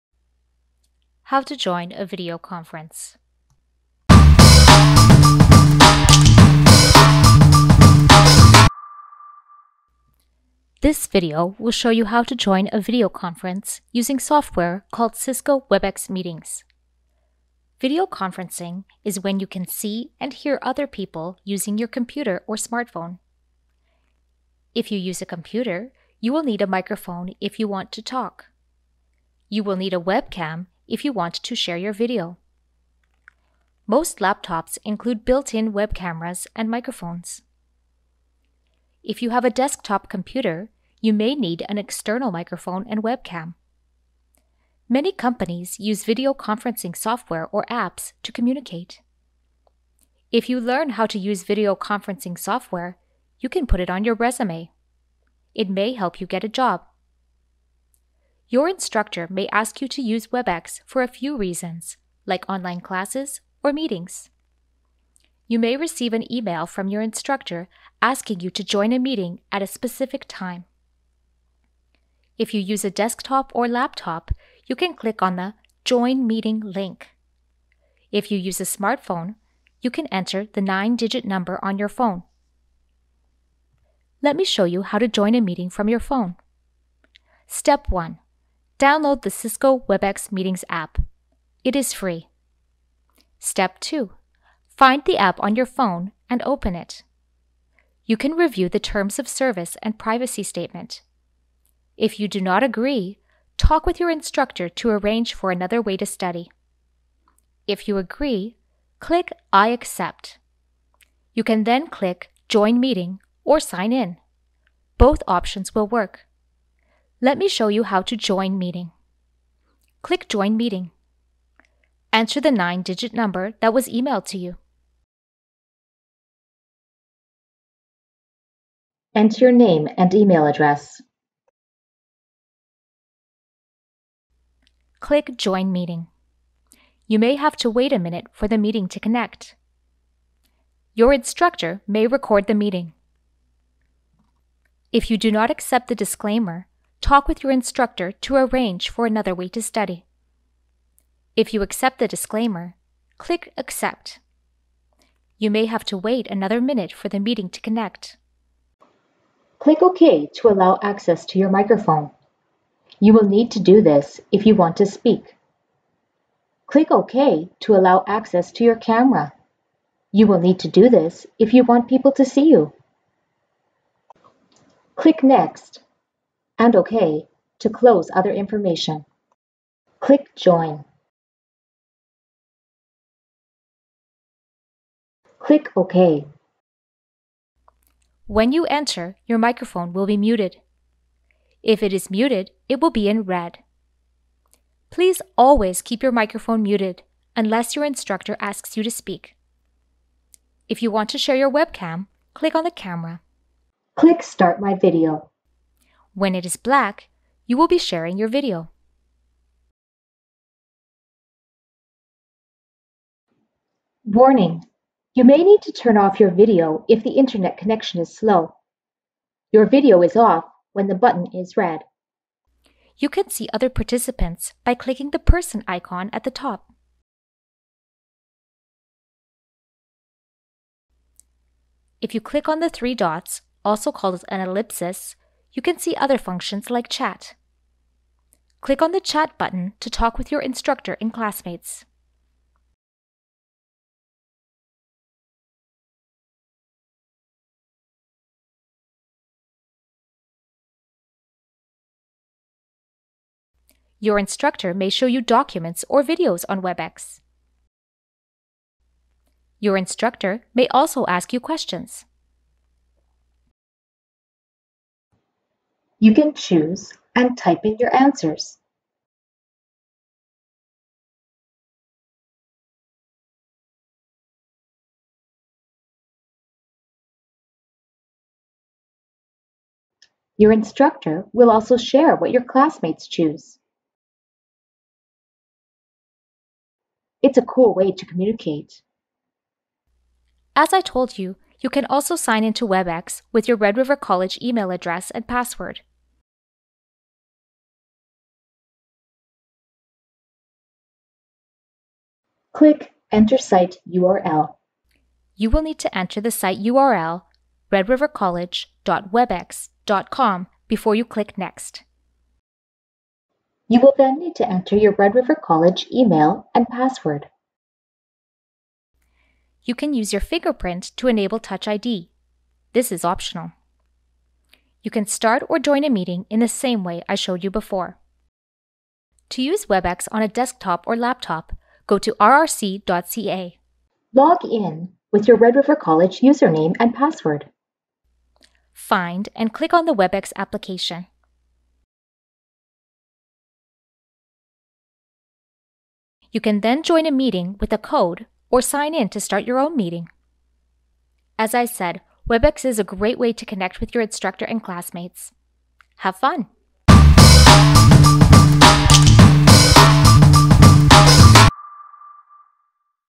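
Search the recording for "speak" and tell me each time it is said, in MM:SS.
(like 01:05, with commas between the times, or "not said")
02:44, 03:18.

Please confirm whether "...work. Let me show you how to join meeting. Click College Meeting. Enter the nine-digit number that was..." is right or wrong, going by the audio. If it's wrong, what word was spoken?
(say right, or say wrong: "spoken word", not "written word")
wrong: "Join", not "College".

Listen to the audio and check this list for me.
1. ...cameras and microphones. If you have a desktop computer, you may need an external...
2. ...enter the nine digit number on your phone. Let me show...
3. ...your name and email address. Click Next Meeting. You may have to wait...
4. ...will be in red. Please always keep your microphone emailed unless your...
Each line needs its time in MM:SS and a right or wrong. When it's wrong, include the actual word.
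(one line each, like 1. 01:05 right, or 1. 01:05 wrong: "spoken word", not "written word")
1. 00:35 right
2. 01:20 right
3. 02:09 wrong: "Join", not "Next"
4. 03:12 wrong: "muted", not "emailed".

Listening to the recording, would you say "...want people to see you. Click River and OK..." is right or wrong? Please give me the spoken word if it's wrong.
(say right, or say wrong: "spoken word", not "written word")
wrong: "Next", not "River".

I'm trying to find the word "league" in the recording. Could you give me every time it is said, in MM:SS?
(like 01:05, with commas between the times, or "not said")
not said.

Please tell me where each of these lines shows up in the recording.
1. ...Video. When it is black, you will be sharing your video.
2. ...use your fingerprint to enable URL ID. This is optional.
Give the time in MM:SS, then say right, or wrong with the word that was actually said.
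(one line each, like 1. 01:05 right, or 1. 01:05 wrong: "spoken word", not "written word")
1. 03:24 right
2. 05:19 wrong: "Touch", not "URL".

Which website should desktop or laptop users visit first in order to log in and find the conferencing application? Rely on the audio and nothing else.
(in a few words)
rrc.ca.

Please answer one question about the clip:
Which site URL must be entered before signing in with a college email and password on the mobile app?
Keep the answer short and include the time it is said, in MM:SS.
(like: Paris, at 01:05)
redrivercollege.webex.com, at 05:07.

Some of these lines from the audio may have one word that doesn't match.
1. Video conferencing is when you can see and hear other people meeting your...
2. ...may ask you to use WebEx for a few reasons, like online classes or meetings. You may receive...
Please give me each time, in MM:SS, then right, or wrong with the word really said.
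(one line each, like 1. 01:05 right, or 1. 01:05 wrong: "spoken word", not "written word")
1. 00:17 wrong: "using", not "meeting"
2. 00:59 right.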